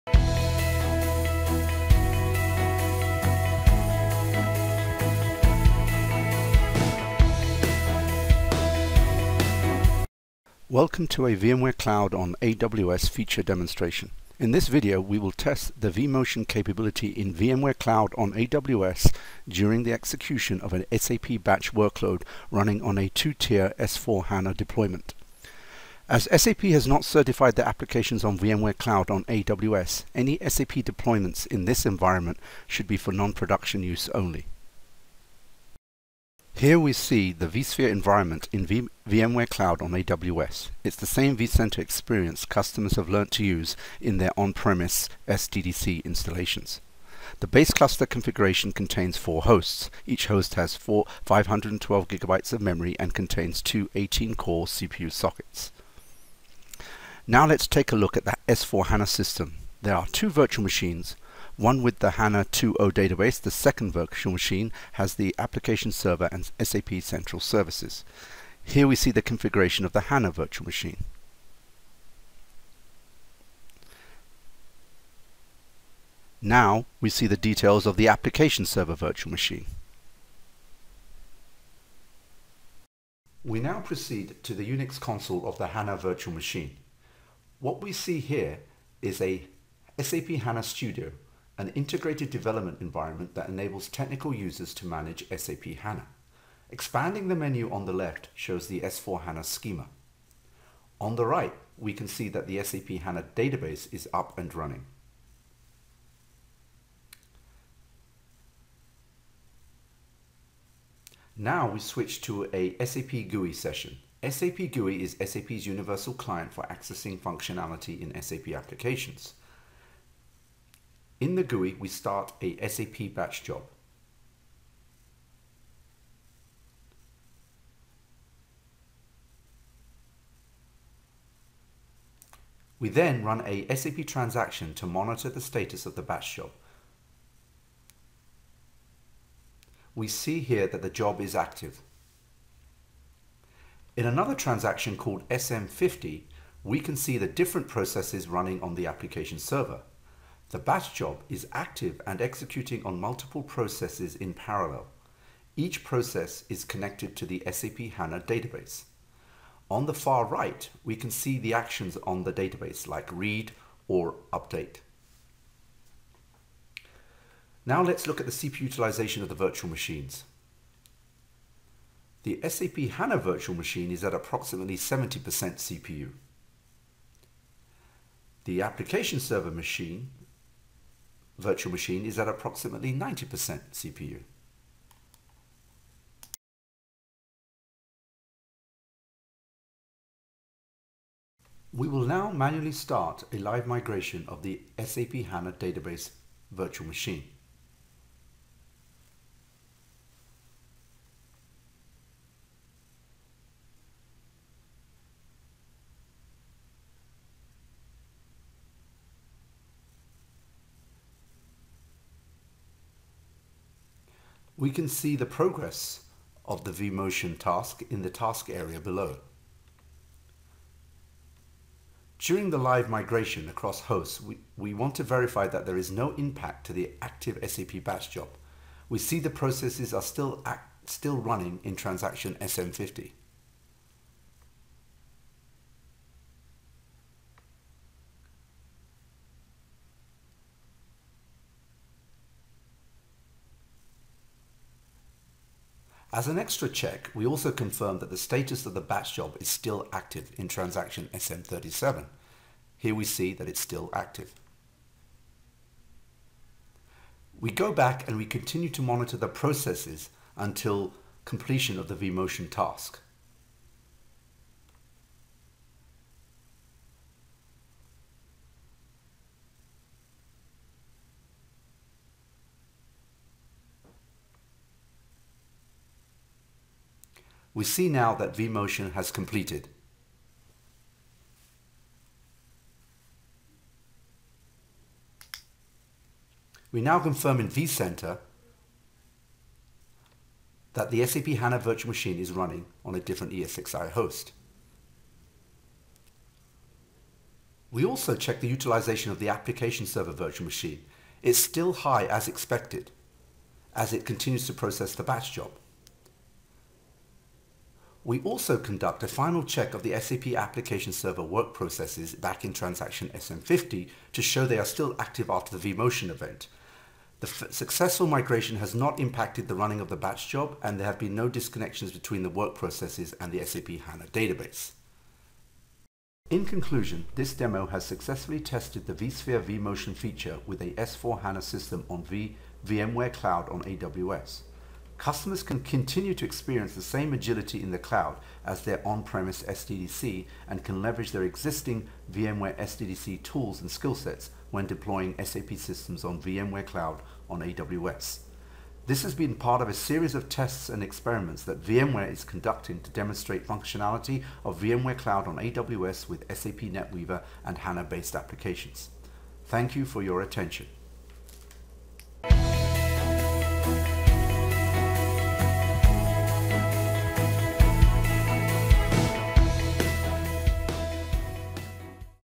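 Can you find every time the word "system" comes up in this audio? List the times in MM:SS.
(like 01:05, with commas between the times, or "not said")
00:59, 05:31, 05:45.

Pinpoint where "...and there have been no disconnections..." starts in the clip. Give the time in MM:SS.
05:20.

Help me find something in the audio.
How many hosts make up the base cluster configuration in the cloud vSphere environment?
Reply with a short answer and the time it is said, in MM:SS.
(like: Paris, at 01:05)
4, at 00:49.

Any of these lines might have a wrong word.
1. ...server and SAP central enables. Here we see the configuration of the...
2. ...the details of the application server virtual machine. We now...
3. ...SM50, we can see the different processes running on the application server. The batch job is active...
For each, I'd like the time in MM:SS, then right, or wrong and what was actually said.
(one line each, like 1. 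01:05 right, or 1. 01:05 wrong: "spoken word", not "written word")
1. 01:05 wrong: "services", not "enables"
2. 01:17 right
3. 02:25 right.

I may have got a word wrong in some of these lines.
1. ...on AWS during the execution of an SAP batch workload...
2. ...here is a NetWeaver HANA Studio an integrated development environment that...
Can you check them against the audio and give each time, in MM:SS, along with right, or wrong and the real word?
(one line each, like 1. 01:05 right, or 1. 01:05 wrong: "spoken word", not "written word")
1. 00:18 right
2. 01:28 wrong: "SAP", not "NetWeaver".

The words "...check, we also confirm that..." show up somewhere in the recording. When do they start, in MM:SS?
04:06.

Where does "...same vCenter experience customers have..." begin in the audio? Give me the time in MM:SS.
00:41.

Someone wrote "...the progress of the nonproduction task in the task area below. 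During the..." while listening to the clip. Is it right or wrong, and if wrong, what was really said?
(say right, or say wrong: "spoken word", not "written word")
wrong: "vMotion", not "nonproduction".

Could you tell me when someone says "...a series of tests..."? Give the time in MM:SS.
05:49.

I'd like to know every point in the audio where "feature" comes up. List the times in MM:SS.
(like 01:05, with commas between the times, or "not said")
00:13, 05:29.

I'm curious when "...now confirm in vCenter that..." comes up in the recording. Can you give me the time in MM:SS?
04:46.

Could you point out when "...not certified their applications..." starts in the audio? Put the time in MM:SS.
00:26.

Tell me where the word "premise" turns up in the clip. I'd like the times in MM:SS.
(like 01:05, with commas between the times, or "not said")
00:44, 05:38.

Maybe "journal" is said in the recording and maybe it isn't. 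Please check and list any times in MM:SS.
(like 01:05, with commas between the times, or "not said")
not said.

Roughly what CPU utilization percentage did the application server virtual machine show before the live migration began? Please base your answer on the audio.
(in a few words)
90%.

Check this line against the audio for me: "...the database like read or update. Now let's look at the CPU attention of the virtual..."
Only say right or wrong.
wrong.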